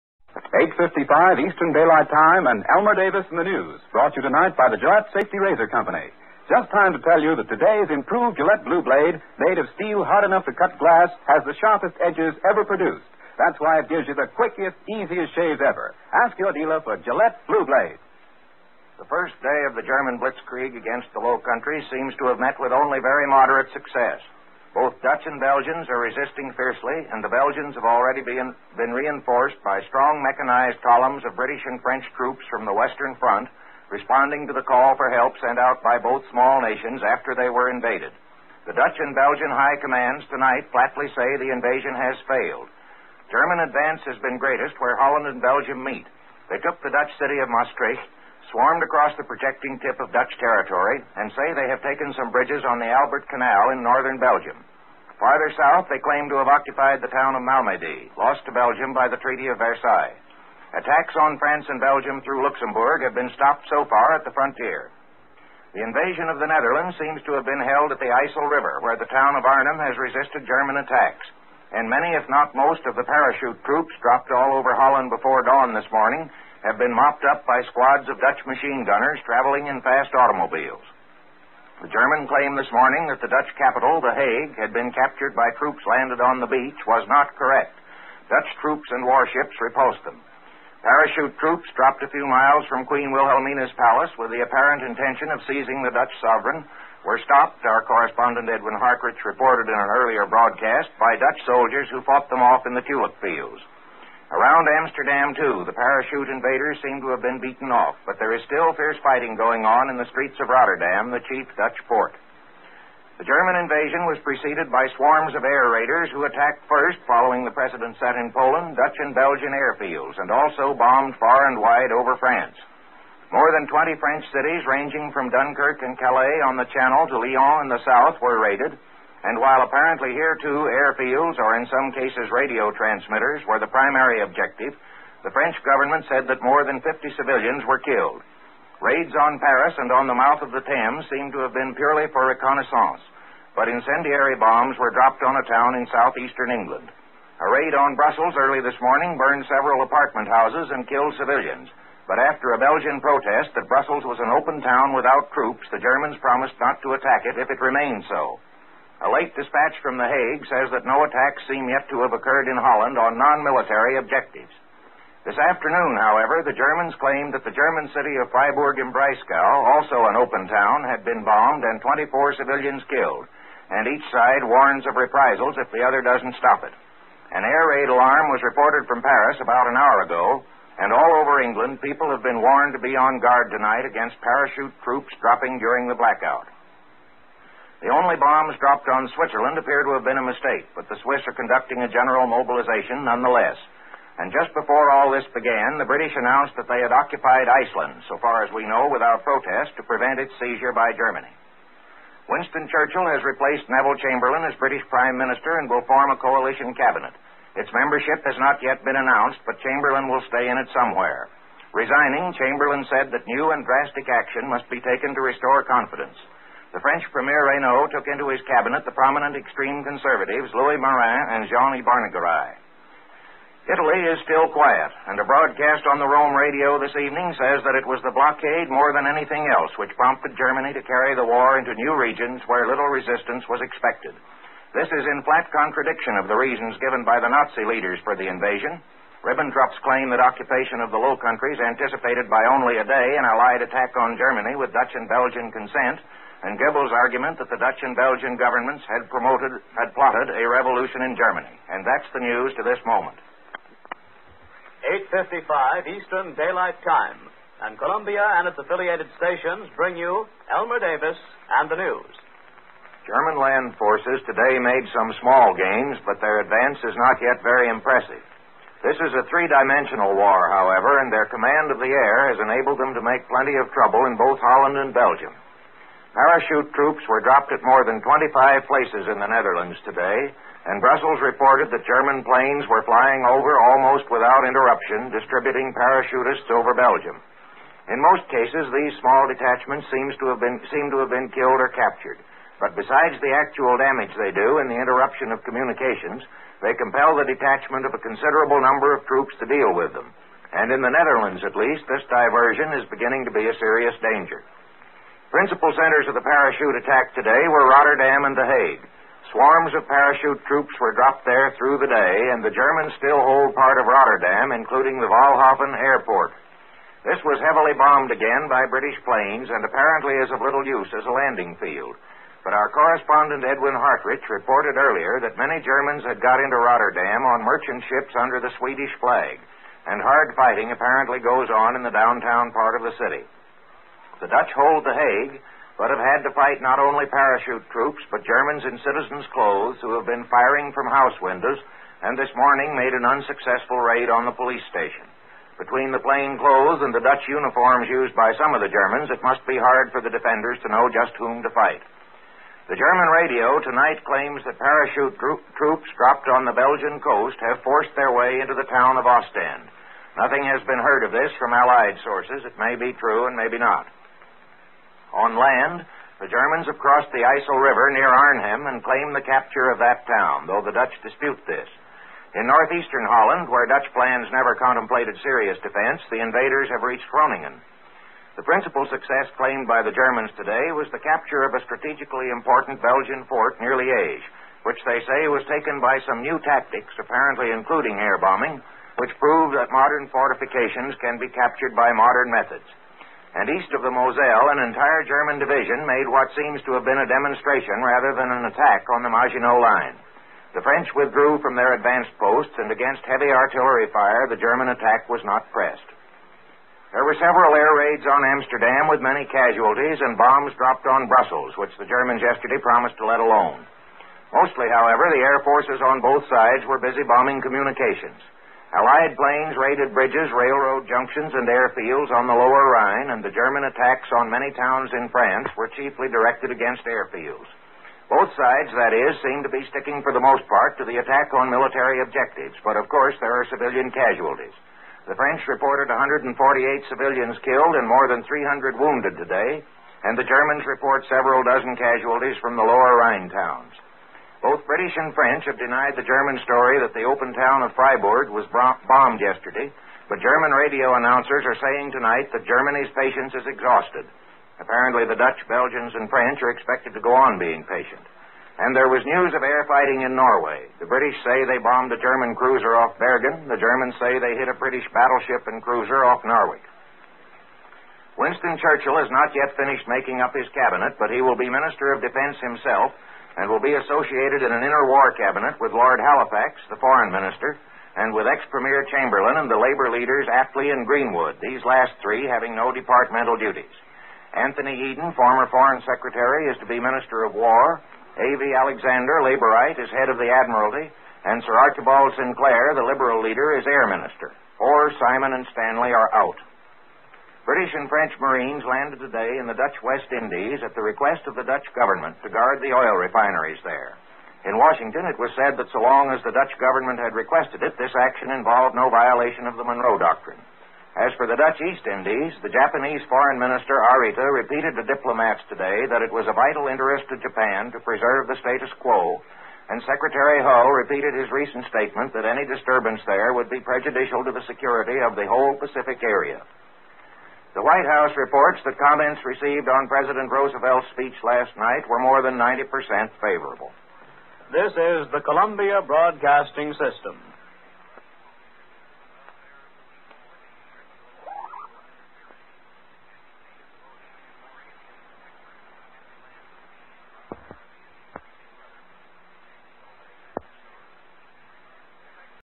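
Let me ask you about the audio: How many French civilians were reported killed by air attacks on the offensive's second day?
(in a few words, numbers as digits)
148.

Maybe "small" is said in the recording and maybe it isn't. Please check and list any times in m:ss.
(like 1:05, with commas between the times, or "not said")
0:36, 4:25, 4:48.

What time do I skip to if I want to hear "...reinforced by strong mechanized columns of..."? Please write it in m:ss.
0:28.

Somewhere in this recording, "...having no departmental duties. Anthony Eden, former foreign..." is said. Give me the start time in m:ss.
8:02.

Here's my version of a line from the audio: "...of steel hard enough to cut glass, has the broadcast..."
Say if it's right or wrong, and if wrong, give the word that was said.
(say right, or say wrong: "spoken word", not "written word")
wrong: "sharpest", not "broadcast".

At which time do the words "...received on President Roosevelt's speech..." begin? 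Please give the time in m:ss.
8:49.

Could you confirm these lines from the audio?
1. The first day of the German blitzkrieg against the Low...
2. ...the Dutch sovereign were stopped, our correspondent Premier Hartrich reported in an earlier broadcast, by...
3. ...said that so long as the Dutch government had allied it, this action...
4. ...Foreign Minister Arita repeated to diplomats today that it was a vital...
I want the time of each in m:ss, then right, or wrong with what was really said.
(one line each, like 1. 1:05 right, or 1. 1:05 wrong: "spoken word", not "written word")
1. 0:18 right
2. 1:35 wrong: "Edwin", not "Premier"
3. 8:25 wrong: "requested", not "allied"
4. 8:33 right.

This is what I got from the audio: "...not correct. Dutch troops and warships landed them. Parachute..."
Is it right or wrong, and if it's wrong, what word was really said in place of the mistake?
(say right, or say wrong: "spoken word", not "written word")
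wrong: "repulsed", not "landed".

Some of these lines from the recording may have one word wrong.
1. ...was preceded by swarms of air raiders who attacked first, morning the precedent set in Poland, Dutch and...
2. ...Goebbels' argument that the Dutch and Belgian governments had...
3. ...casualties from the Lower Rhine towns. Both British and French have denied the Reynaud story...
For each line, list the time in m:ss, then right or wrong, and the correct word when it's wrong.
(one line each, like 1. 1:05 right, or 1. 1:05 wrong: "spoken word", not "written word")
1. 1:54 wrong: "following", not "morning"
2. 4:06 right
3. 7:21 wrong: "German", not "Reynaud".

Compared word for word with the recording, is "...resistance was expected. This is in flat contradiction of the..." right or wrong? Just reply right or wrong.
right.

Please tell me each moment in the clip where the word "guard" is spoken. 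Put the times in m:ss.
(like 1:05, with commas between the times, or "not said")
3:03, 8:22.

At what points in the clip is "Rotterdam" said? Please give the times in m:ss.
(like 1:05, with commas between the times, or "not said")
1:50, 5:07, 5:13, 5:26.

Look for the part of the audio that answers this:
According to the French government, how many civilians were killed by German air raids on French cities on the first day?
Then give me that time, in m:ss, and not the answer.
2:16.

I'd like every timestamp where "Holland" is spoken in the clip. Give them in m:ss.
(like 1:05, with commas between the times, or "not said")
0:44, 1:14, 2:42, 4:34, 6:13.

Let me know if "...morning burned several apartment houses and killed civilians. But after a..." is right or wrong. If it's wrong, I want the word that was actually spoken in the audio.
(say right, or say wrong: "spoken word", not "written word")
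right.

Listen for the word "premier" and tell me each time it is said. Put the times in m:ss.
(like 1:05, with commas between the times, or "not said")
3:37, 7:58.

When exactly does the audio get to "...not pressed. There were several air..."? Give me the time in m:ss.
6:45.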